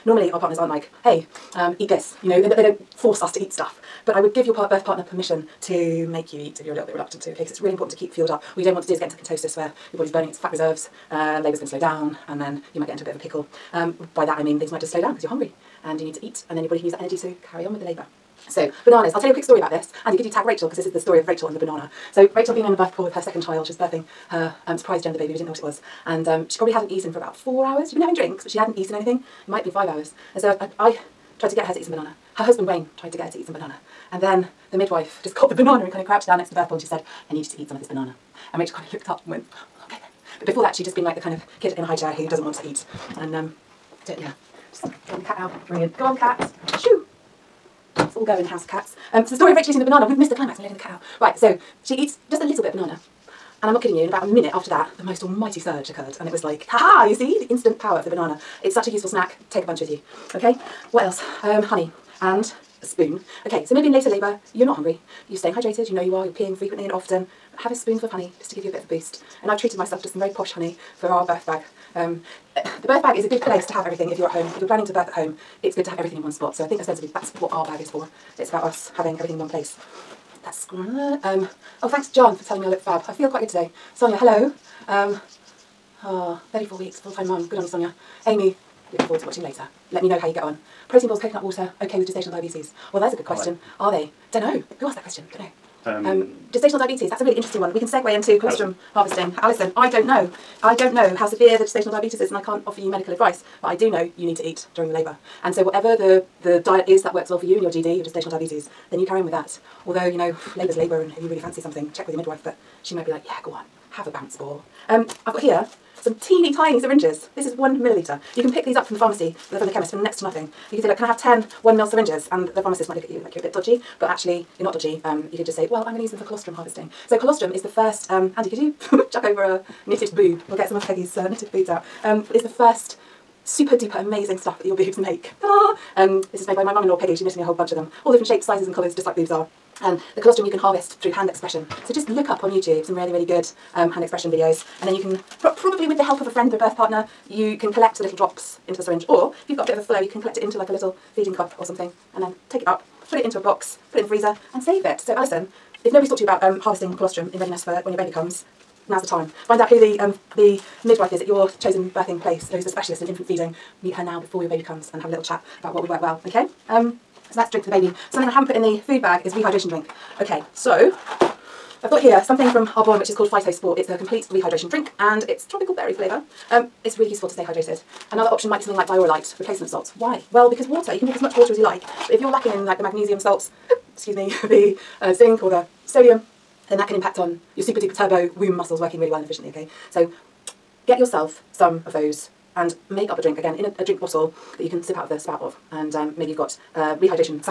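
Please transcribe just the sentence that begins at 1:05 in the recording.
You're staying hydrated, you know you are, you're peeing frequently and often.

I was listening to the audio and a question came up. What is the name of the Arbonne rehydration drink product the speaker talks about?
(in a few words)
Phytosport.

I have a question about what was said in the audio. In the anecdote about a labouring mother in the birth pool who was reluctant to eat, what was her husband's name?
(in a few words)
Wayne.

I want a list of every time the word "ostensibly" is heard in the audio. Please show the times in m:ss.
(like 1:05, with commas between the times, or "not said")
1:16.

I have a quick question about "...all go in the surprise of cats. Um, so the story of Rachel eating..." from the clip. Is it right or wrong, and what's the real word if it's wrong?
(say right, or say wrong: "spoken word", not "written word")
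wrong: "house", not "surprise".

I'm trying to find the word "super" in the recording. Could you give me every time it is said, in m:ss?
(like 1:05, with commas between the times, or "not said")
2:13, 3:07.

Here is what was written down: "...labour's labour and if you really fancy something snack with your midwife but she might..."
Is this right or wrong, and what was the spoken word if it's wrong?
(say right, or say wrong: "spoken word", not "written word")
wrong: "check", not "snack".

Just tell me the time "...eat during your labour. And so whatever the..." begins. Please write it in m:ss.
1:44.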